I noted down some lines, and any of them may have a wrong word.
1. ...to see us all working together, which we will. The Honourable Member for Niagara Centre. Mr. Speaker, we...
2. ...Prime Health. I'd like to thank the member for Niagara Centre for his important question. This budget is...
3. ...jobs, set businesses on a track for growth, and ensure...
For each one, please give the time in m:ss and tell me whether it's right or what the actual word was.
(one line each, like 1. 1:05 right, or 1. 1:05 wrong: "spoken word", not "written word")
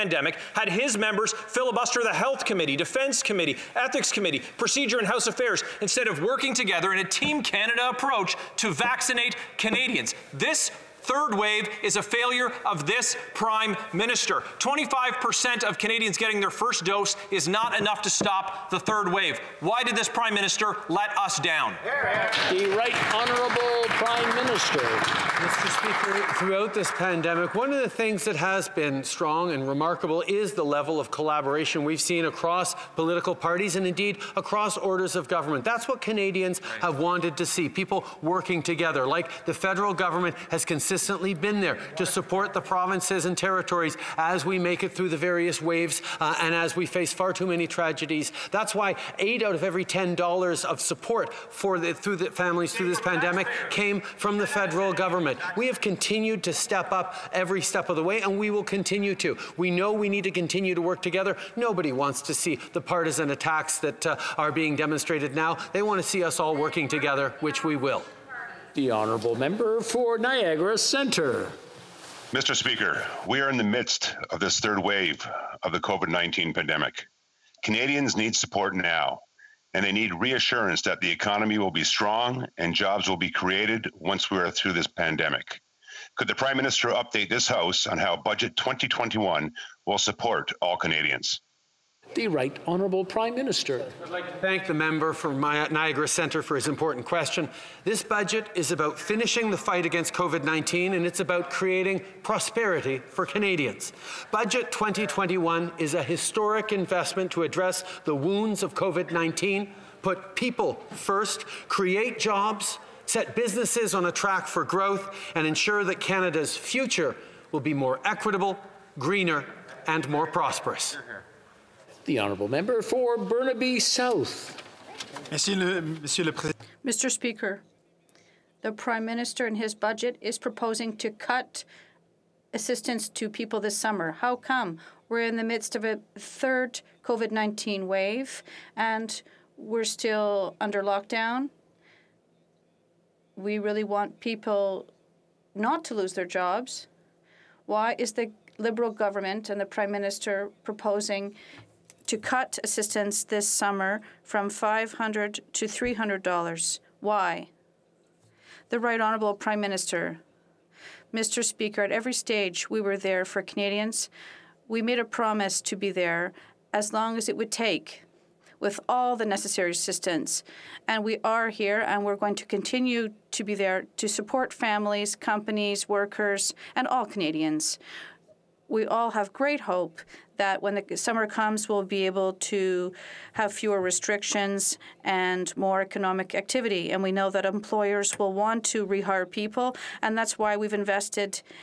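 1. 1:06 right
2. 1:33 wrong: "Minister", not "Health"
3. 1:52 right.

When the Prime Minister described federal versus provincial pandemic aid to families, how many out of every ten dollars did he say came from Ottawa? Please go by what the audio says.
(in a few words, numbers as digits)
8.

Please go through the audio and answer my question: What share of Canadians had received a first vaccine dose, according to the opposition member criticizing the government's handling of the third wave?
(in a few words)
25%.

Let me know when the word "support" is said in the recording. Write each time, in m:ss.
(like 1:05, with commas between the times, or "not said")
0:42, 0:50, 1:18, 1:29, 2:54.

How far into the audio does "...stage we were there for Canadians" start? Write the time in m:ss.
2:42.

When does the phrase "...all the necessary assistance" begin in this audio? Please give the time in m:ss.
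2:48.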